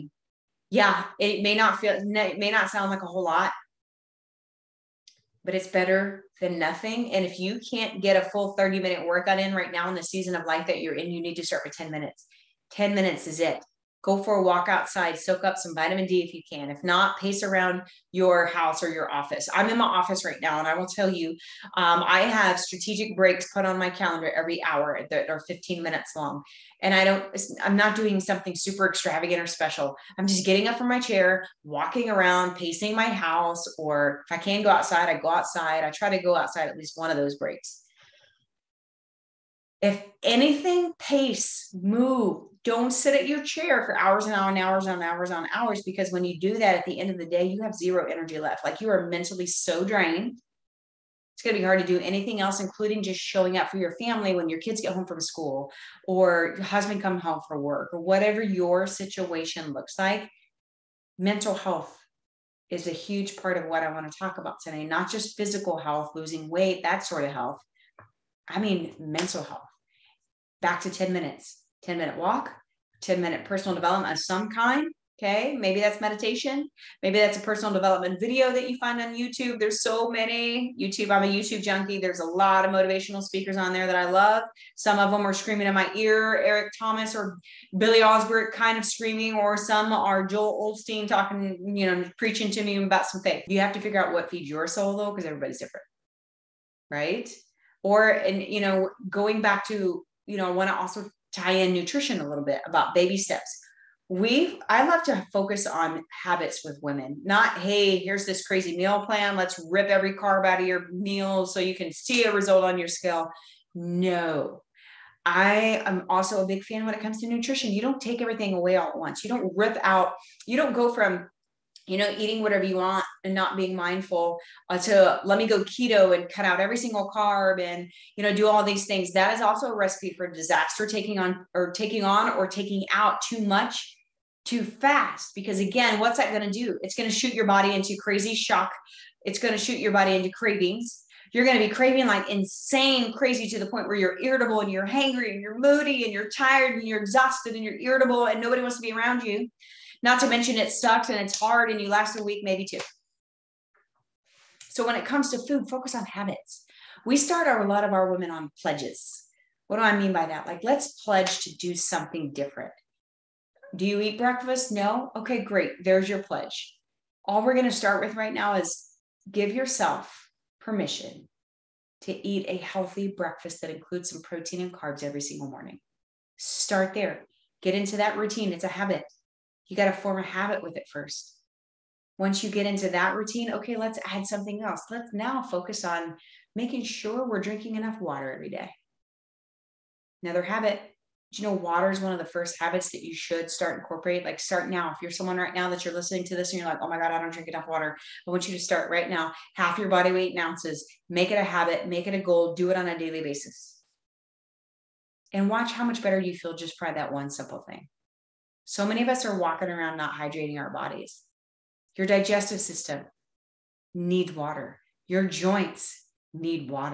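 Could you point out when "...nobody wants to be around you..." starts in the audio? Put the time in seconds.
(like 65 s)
148 s.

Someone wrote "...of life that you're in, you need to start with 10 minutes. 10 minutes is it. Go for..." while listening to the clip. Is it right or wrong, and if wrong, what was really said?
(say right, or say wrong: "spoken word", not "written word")
right.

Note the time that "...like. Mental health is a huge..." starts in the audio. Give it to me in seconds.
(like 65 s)
59 s.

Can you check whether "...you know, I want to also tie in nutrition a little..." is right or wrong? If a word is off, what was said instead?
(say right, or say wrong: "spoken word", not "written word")
right.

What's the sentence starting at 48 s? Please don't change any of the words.
Like you are mentally so drained.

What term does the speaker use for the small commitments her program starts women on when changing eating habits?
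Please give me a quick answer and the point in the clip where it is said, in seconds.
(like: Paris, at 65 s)
Pledges, at 158 s.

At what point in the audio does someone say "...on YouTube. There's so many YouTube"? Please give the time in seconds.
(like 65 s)
79 s.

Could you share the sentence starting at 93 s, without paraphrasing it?
You have to figure out what feeds your soul though, because everybody's different.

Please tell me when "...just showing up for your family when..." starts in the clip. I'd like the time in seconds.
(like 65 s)
53 s.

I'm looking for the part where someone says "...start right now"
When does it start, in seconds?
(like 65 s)
198 s.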